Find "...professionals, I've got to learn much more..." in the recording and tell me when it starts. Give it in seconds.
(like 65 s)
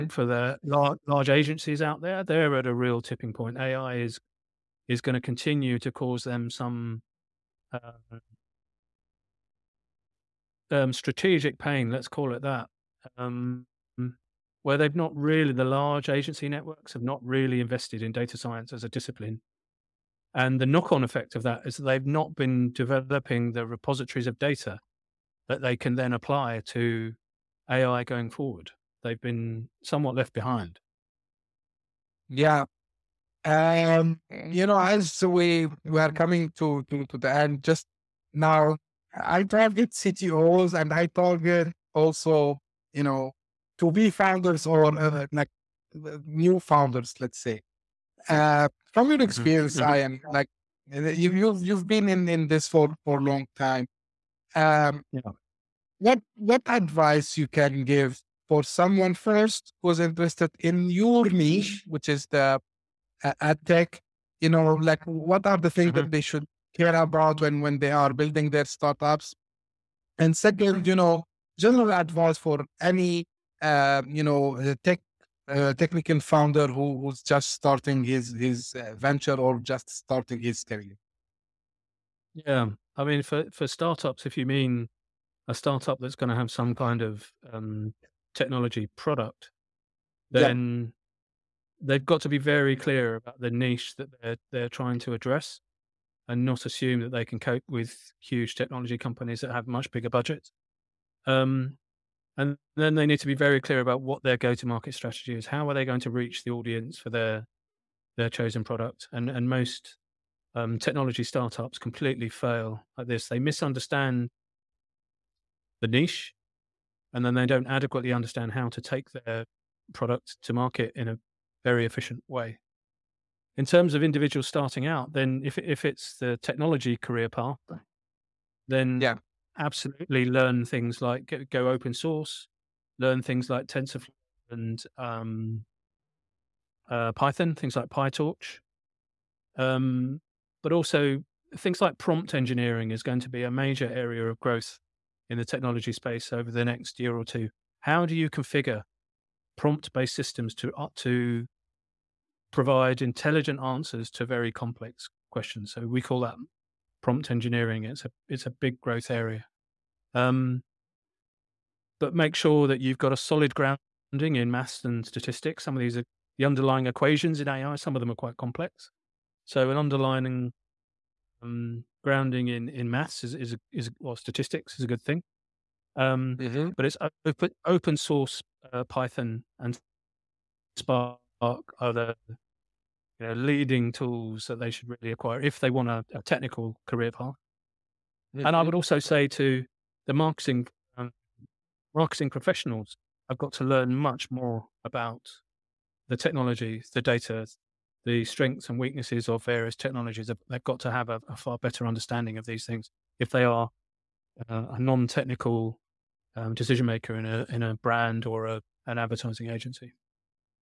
192 s.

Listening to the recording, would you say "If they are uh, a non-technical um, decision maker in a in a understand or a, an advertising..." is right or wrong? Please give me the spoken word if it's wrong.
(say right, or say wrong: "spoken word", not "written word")
wrong: "brand", not "understand".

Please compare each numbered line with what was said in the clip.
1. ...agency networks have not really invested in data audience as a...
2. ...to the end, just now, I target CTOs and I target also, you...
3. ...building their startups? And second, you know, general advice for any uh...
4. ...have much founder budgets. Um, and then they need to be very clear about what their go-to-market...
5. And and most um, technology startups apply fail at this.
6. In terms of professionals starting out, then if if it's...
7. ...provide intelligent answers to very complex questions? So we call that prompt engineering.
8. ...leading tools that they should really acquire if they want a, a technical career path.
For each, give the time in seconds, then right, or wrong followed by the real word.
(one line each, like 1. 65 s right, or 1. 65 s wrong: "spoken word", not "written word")
1. 16 s wrong: "science", not "audience"
2. 37 s right
3. 68 s right
4. 99 s wrong: "bigger", not "founder"
5. 109 s wrong: "completely", not "apply"
6. 123 s wrong: "individuals", not "professionals"
7. 152 s right
8. 183 s right.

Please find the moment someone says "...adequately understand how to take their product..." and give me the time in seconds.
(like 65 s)
117 s.